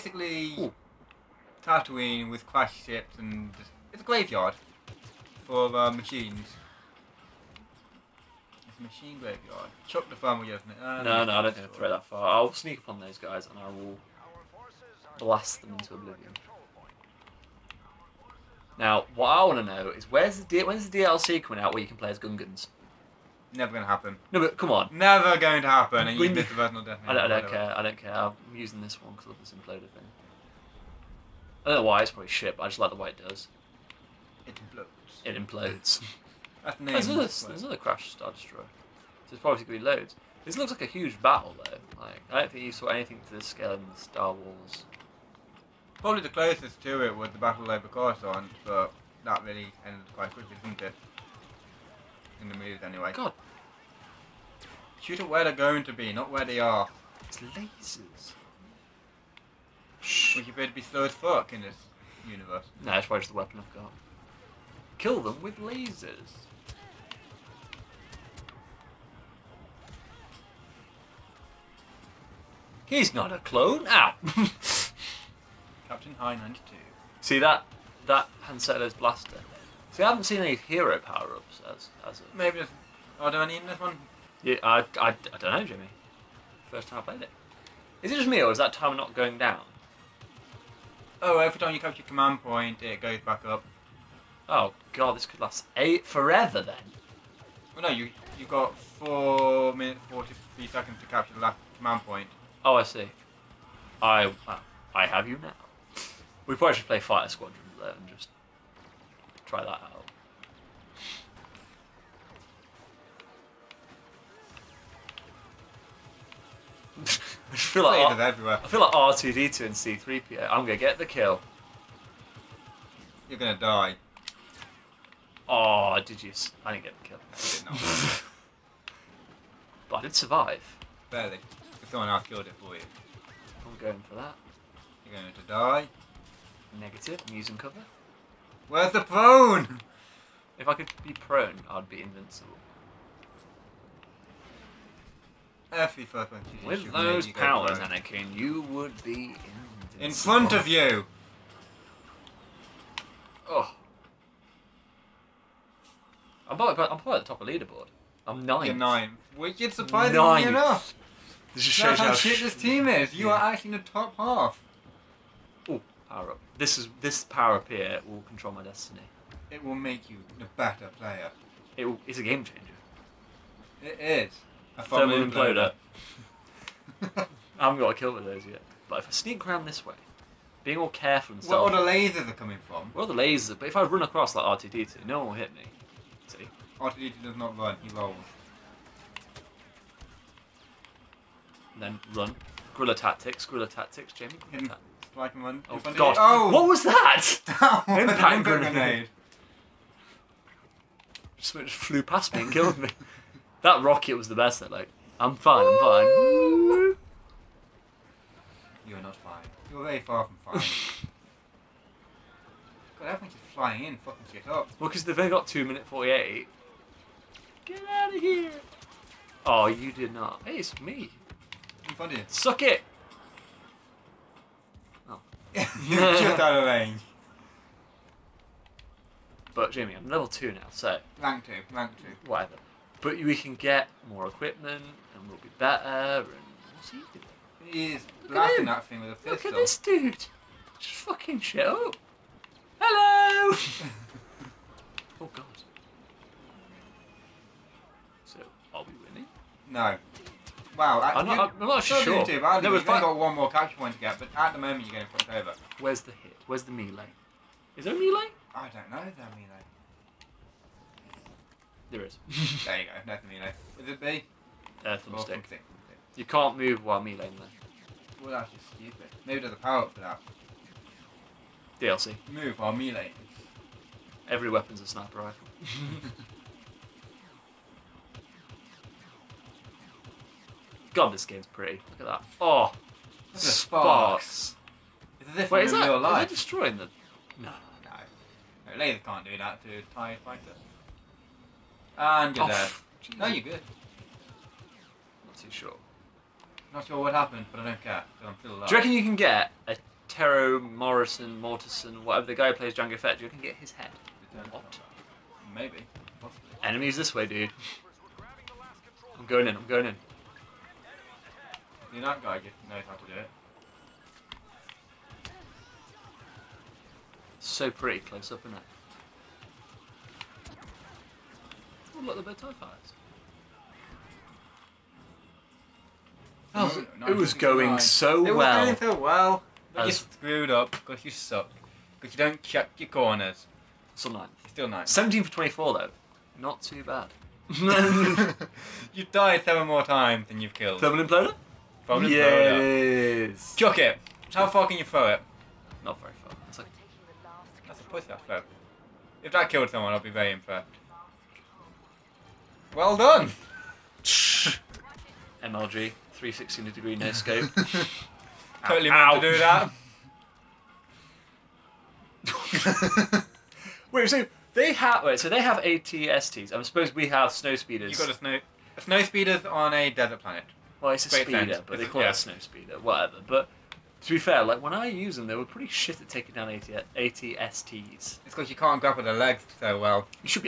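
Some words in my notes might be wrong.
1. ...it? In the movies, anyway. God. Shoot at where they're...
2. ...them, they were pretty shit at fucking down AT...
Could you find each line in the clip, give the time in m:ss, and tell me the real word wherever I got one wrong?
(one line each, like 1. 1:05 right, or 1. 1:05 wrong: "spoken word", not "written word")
1. 0:50 right
2. 6:15 wrong: "taking", not "fucking".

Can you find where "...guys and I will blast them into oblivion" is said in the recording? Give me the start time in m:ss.
0:13.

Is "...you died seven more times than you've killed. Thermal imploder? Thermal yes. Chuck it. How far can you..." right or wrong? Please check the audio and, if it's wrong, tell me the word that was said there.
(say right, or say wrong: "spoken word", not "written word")
right.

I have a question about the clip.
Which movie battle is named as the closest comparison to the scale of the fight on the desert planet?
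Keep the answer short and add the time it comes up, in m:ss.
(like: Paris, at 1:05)
Battle of Coruscant, at 0:47.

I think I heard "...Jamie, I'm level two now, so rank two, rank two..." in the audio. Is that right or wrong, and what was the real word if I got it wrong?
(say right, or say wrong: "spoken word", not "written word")
right.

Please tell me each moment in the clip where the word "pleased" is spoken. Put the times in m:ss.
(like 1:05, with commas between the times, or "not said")
not said.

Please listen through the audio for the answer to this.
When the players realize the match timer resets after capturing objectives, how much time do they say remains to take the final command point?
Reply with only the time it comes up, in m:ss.
1:38.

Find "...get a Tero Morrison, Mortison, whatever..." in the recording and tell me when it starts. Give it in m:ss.
4:59.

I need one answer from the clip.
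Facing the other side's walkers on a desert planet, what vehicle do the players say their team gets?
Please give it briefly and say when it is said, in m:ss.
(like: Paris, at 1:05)
Snow speeders, at 6:07.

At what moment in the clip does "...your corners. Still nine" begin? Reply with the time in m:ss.
5:32.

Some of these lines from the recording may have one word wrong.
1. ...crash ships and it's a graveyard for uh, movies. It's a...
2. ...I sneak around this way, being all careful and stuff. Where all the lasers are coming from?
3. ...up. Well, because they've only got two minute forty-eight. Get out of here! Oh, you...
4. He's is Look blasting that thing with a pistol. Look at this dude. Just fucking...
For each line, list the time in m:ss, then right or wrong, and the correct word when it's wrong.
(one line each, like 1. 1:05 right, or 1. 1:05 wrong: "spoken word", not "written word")
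1. 0:02 wrong: "machines", not "movies"
2. 2:59 right
3. 3:34 right
4. 3:57 right.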